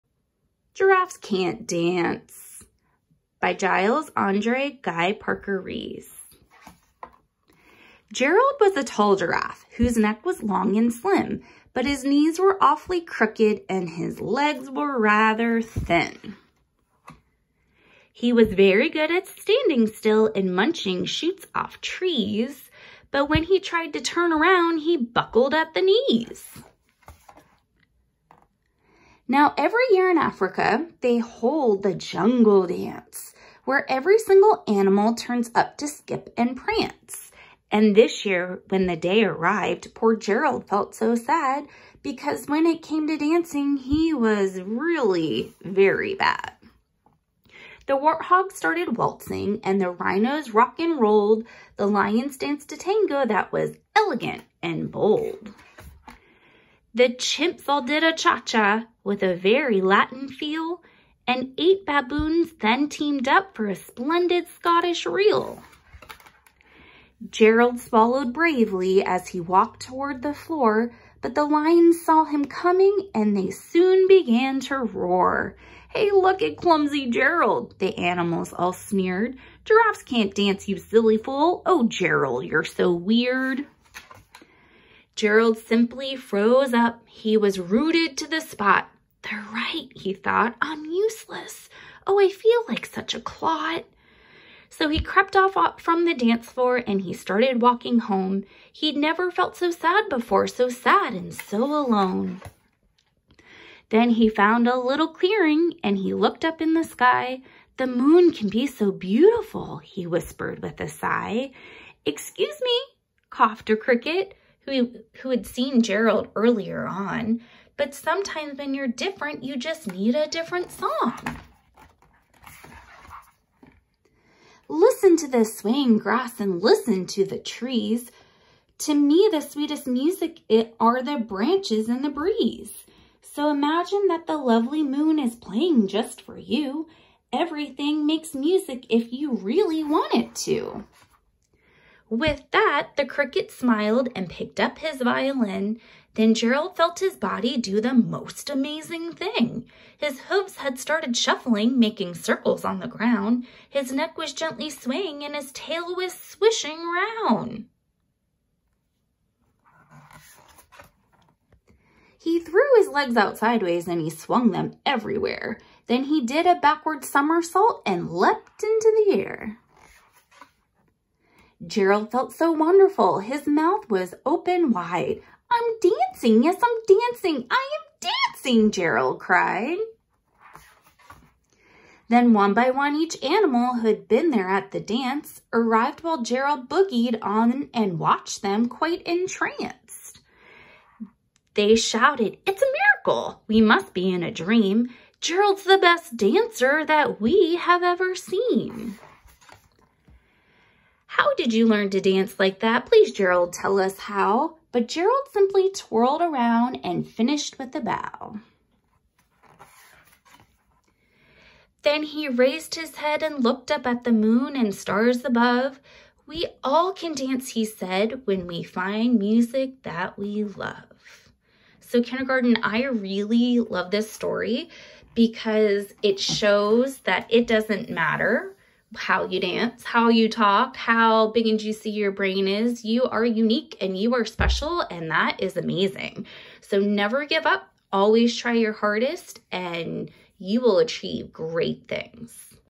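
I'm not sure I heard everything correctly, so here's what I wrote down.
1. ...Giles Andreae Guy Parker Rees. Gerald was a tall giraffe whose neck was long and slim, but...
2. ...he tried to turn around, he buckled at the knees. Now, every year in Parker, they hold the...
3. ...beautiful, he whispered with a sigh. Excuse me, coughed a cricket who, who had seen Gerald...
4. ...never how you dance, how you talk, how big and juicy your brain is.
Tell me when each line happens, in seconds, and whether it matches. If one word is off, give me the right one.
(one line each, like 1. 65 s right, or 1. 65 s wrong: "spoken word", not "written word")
1. 3 s right
2. 23 s wrong: "Africa", not "Parker"
3. 108 s right
4. 227 s wrong: "matter", not "never".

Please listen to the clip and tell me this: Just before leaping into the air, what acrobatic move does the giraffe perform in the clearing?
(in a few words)
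backward somersault.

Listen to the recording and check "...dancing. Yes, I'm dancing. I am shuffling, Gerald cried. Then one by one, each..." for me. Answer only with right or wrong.
wrong.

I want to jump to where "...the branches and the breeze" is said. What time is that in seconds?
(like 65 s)
131 s.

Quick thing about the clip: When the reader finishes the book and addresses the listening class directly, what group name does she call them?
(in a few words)
kindergarten.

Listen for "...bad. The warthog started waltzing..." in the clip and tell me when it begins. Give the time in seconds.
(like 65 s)
46 s.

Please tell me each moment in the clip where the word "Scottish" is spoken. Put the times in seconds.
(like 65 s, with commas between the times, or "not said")
64 s.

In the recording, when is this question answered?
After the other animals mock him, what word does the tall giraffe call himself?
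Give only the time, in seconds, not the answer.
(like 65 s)
93 s.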